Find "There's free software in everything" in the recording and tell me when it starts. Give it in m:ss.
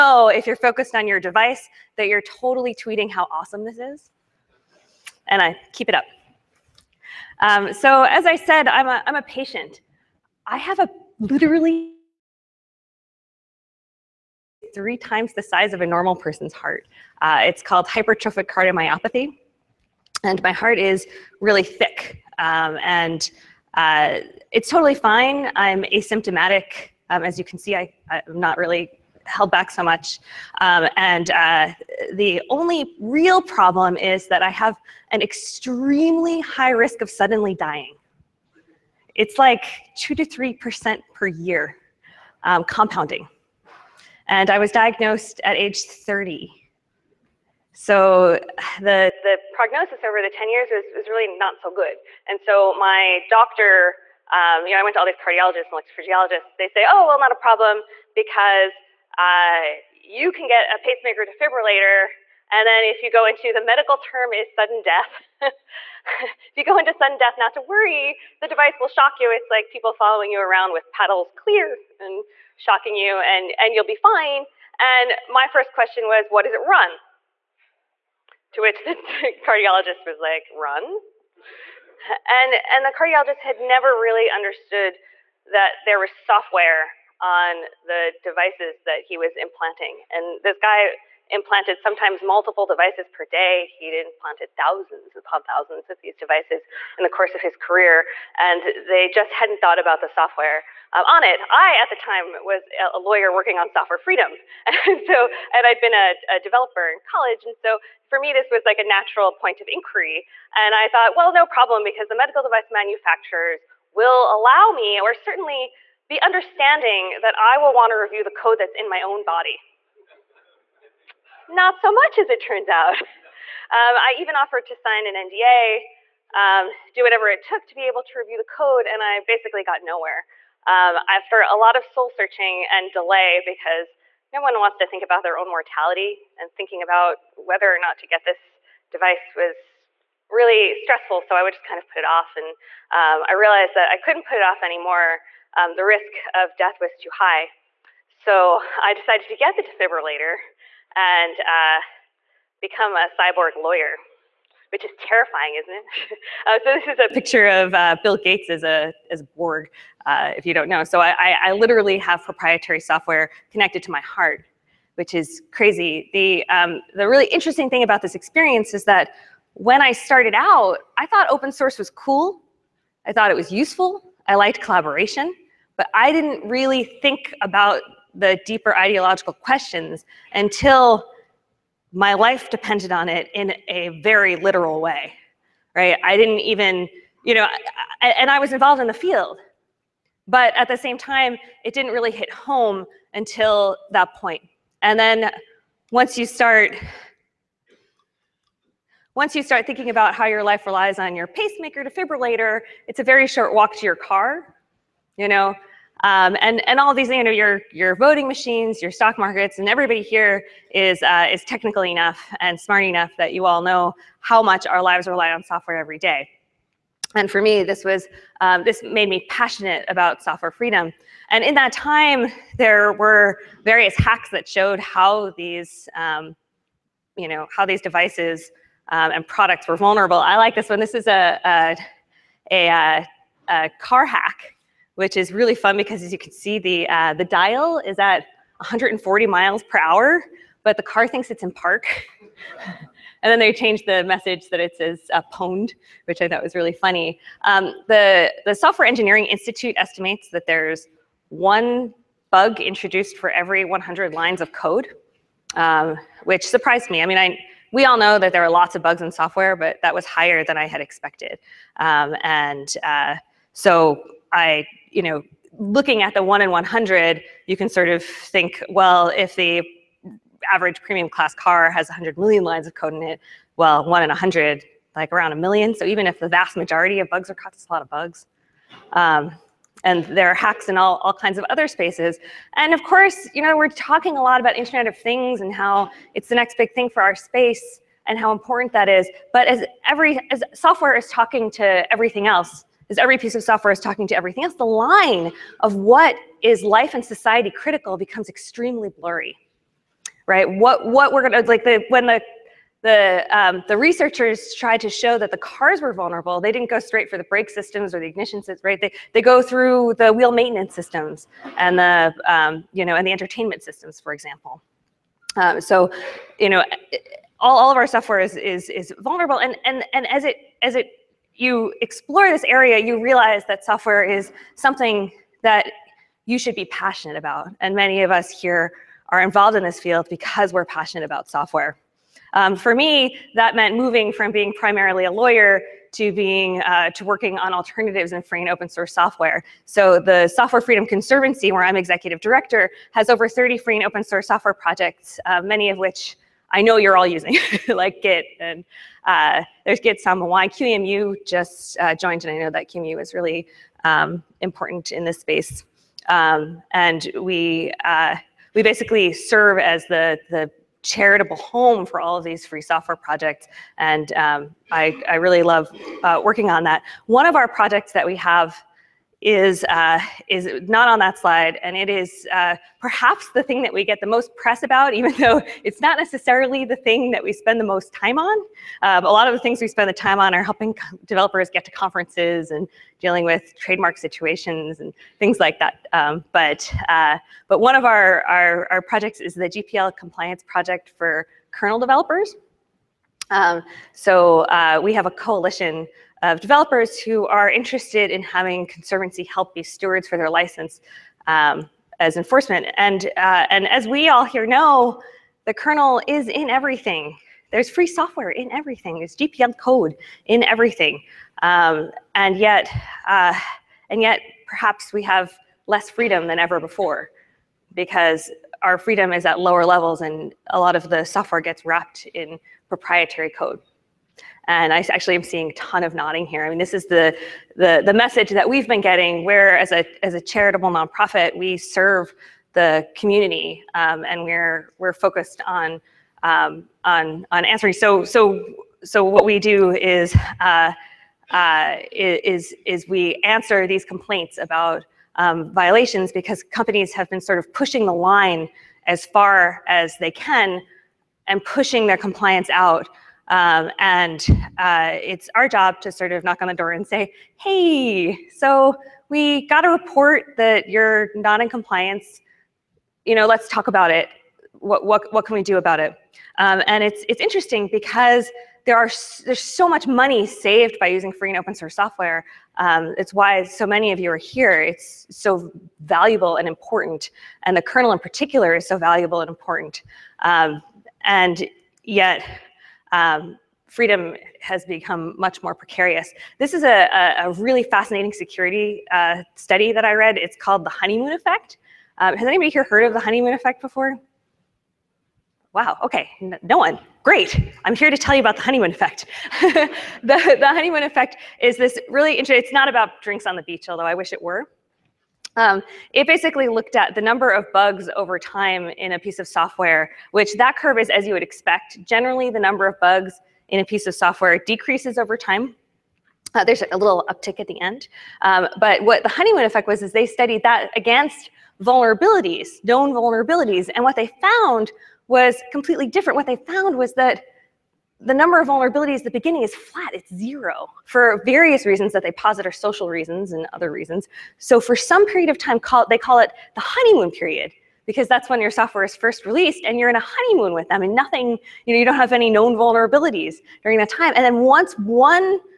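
6:47.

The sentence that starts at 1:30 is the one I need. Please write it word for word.
And this guy implanted sometimes multiple devices per day.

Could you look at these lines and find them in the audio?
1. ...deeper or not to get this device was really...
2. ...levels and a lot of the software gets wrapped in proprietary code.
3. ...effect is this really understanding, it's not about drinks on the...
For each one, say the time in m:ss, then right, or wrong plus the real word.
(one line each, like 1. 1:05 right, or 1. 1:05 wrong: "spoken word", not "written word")
1. 2:17 wrong: "whether", not "deeper"
2. 6:59 right
3. 8:20 wrong: "interesting", not "understanding".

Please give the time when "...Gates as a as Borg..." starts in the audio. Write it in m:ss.
2:38.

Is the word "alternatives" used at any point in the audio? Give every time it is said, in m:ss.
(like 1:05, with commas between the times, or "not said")
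5:37.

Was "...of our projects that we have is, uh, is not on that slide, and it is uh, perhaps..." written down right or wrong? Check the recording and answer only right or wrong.
right.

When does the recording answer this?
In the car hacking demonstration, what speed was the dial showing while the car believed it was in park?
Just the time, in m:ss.
3:58.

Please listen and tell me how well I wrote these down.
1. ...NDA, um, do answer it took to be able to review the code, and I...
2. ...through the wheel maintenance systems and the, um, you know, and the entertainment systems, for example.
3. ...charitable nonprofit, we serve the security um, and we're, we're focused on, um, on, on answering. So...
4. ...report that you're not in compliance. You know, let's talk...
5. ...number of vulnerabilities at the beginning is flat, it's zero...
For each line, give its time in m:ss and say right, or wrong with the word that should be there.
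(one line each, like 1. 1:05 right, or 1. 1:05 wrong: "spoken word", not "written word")
1. 2:05 wrong: "whatever", not "answer"
2. 5:09 right
3. 7:10 wrong: "community", not "security"
4. 7:39 right
5. 8:48 right.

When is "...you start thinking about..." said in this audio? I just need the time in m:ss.
3:19.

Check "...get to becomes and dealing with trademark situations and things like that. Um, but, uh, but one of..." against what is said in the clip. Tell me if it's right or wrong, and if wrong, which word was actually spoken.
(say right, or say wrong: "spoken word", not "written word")
wrong: "conferences", not "becomes".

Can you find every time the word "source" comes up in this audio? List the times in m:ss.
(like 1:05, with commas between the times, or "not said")
2:51, 5:38, 5:44, 7:51.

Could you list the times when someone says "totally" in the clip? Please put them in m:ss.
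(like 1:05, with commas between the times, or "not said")
0:02, 0:24.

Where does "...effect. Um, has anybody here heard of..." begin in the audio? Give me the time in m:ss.
8:11.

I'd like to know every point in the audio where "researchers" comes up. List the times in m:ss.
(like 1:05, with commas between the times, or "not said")
5:03.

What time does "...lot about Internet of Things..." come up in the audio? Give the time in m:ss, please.
4:44.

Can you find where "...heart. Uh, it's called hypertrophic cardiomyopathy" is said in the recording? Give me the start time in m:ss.
0:16.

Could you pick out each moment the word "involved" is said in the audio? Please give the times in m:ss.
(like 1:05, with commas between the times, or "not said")
3:08, 5:29.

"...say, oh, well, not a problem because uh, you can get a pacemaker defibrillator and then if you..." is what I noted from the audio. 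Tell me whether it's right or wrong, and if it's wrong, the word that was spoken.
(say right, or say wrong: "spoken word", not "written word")
right.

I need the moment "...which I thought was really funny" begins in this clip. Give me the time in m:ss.
4:06.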